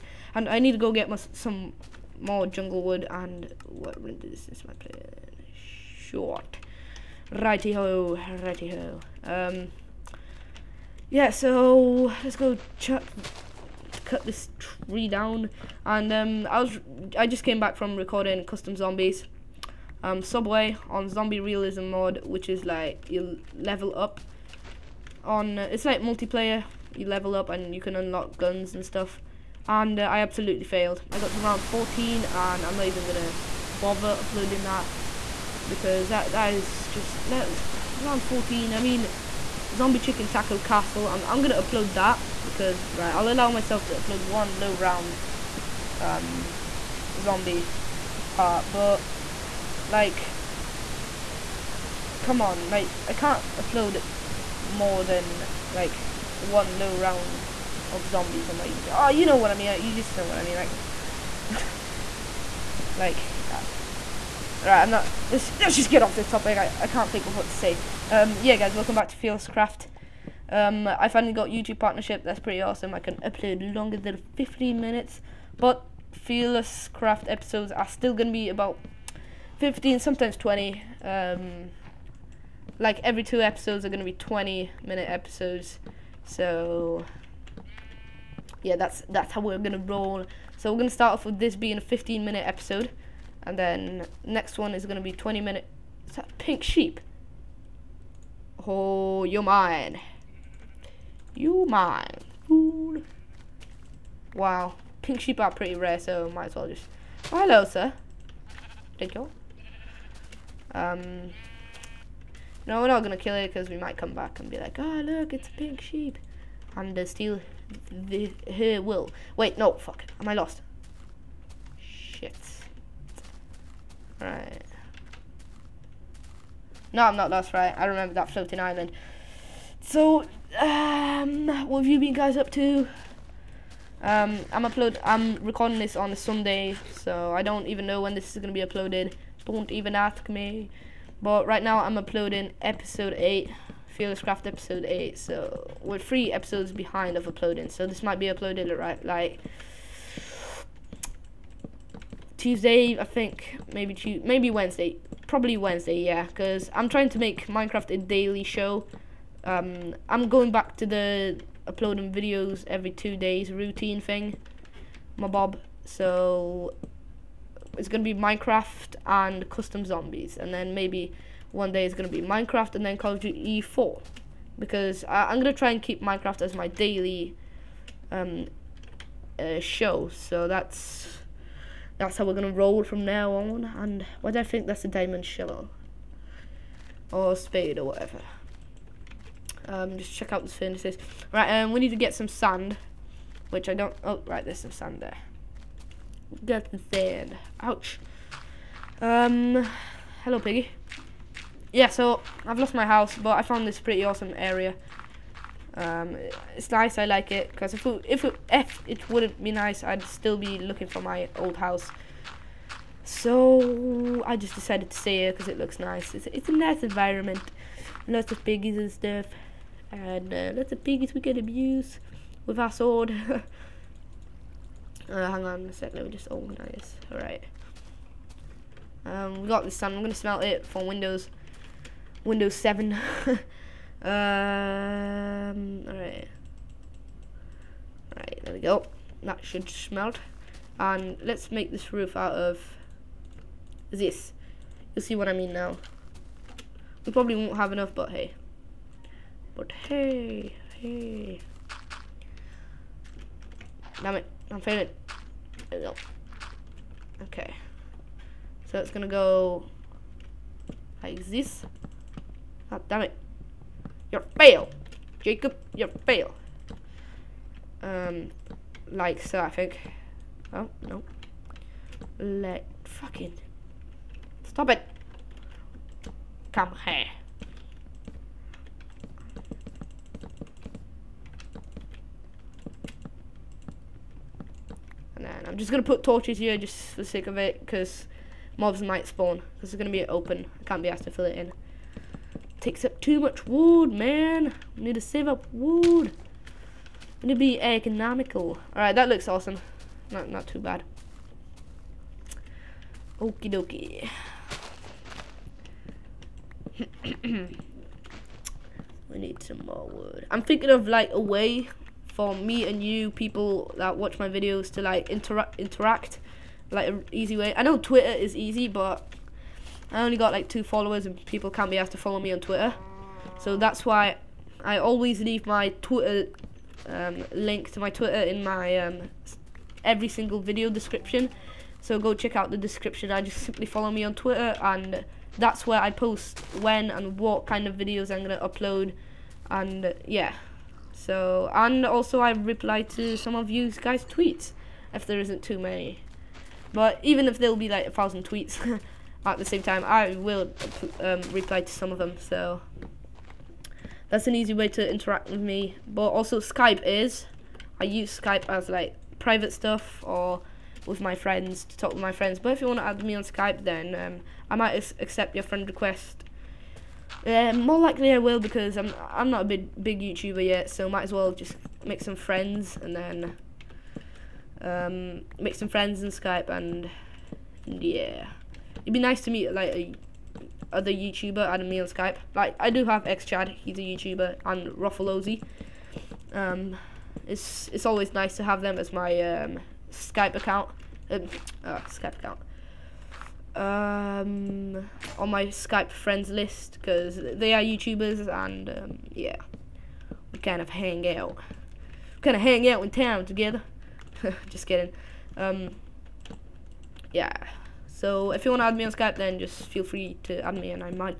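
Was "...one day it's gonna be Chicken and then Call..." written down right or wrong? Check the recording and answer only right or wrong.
wrong.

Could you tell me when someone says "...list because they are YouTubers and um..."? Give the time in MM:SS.
06:36.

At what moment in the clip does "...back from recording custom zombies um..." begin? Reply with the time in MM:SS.
00:17.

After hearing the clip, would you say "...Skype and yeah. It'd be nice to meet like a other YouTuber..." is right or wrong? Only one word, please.
right.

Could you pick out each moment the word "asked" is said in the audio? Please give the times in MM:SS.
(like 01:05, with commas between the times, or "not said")
04:50, 05:21.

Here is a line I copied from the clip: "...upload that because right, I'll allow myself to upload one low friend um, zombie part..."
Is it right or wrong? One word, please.
wrong.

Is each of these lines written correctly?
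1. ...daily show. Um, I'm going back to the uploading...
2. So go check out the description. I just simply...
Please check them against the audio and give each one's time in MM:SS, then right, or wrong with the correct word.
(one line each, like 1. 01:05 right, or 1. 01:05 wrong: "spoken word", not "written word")
1. 02:37 right
2. 05:31 right.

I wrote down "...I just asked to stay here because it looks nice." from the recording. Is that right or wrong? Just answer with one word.
wrong.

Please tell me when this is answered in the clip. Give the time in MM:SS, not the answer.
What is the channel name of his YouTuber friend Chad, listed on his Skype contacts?
06:24.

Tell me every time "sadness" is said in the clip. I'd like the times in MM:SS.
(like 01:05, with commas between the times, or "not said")
not said.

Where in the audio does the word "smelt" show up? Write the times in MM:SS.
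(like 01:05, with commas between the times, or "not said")
03:50, 03:59.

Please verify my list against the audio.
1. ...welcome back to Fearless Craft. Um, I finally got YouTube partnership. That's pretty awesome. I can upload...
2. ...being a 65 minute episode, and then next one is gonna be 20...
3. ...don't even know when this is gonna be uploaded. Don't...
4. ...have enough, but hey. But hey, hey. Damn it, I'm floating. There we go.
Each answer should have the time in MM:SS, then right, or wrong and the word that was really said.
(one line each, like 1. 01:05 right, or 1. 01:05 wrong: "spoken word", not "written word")
1. 01:08 right
2. 01:31 wrong: "15", not "65"
3. 02:17 right
4. 04:07 wrong: "failing", not "floating".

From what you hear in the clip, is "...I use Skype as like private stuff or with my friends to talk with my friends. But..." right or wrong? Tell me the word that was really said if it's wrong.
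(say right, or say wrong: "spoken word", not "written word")
right.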